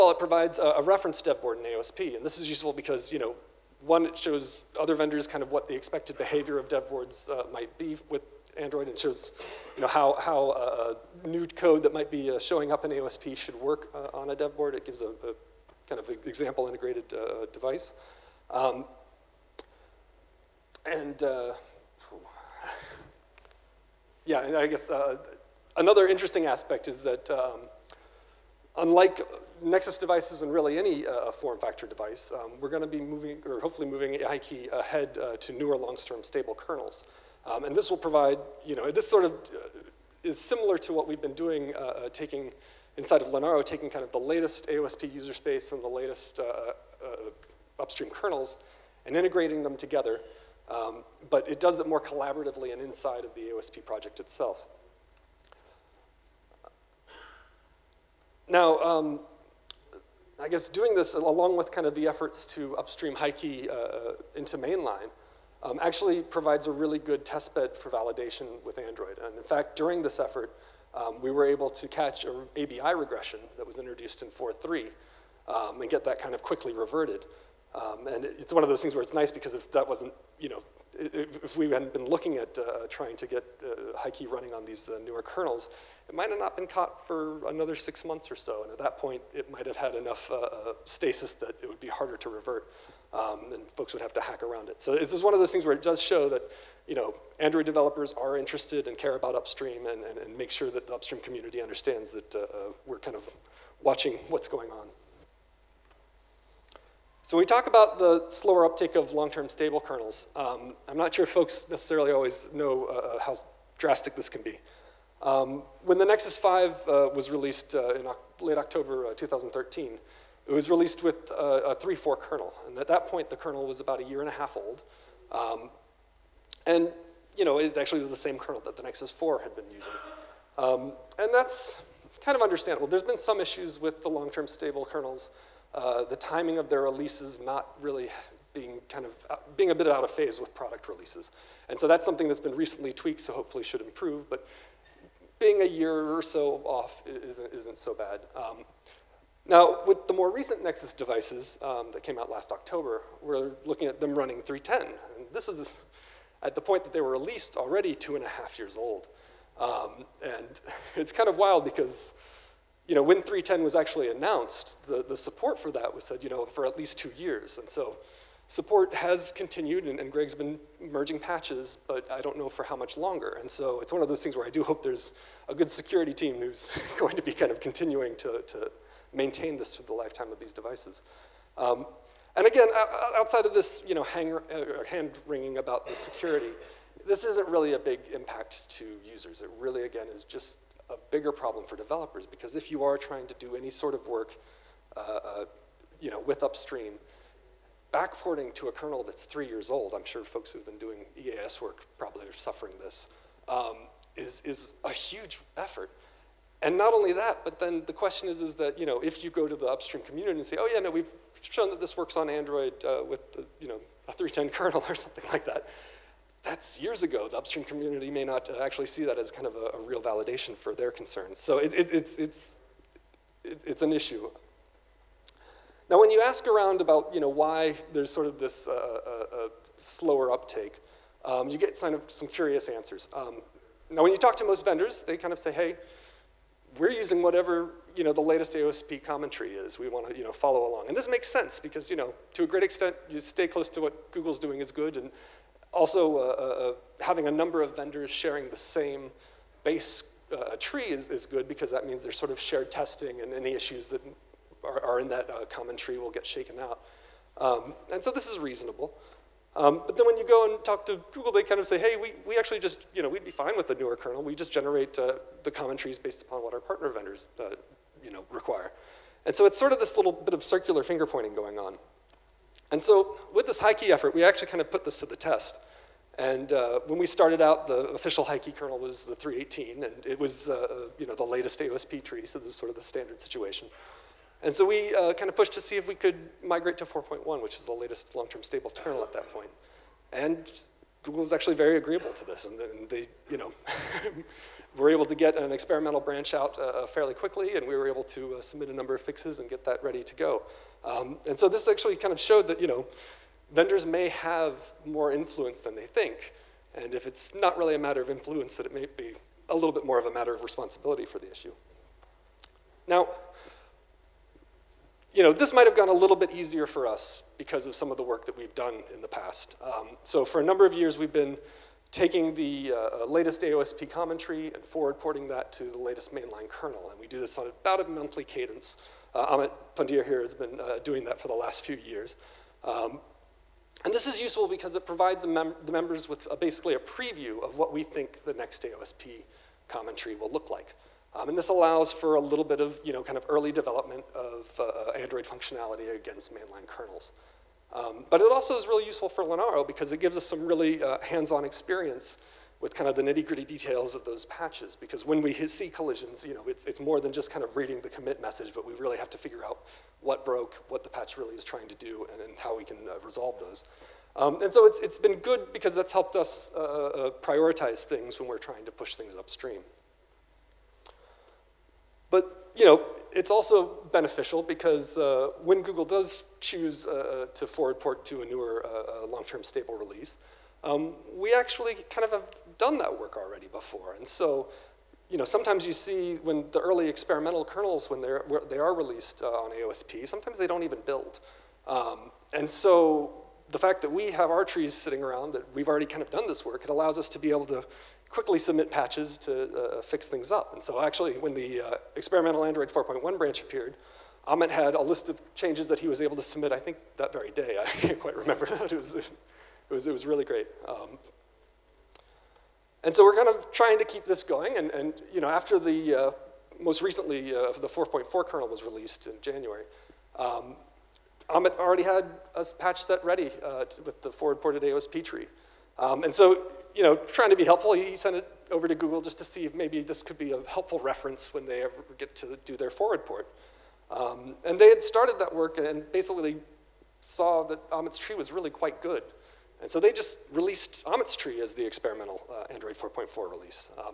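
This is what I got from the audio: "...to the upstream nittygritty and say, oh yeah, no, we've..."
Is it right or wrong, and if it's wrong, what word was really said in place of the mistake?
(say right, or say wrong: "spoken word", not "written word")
wrong: "community", not "nittygritty".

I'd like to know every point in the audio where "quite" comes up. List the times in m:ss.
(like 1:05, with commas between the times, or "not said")
6:47, 7:18.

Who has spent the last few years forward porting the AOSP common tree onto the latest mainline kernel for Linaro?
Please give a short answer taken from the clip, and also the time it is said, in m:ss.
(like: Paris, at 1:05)
Amit Pundir, at 5:29.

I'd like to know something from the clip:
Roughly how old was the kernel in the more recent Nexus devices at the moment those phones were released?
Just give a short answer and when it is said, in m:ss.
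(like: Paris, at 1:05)
two and a half years, at 2:37.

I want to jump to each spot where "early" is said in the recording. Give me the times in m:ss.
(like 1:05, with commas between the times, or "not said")
5:43, 6:26.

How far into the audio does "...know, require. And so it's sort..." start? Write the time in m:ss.
4:28.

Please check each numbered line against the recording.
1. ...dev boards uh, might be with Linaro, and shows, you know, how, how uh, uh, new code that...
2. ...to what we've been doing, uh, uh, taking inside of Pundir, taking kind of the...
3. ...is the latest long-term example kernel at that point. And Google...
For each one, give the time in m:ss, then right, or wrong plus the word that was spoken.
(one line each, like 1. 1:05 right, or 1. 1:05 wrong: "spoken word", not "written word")
1. 0:06 wrong: "Android", not "Linaro"
2. 0:40 wrong: "Linaro", not "Pundir"
3. 4:47 wrong: "stable", not "example".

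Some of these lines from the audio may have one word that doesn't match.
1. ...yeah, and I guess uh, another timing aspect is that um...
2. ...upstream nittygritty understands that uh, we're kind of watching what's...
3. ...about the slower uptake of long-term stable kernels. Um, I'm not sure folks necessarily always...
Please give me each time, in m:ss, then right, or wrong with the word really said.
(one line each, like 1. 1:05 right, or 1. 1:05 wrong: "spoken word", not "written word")
1. 0:24 wrong: "interesting", not "timing"
2. 1:40 wrong: "community", not "nittygritty"
3. 1:47 right.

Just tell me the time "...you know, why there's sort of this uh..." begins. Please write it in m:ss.
3:47.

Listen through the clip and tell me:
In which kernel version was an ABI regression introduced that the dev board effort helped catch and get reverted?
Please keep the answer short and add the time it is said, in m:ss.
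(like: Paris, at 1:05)
4.3, at 1:14.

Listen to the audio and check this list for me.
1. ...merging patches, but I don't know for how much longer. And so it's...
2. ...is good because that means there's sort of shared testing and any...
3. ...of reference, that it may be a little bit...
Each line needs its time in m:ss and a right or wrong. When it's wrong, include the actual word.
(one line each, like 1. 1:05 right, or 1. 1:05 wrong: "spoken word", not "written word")
1. 2:50 right
2. 4:11 right
3. 5:07 wrong: "influence", not "reference".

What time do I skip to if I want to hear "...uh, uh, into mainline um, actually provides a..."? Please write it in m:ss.
1:03.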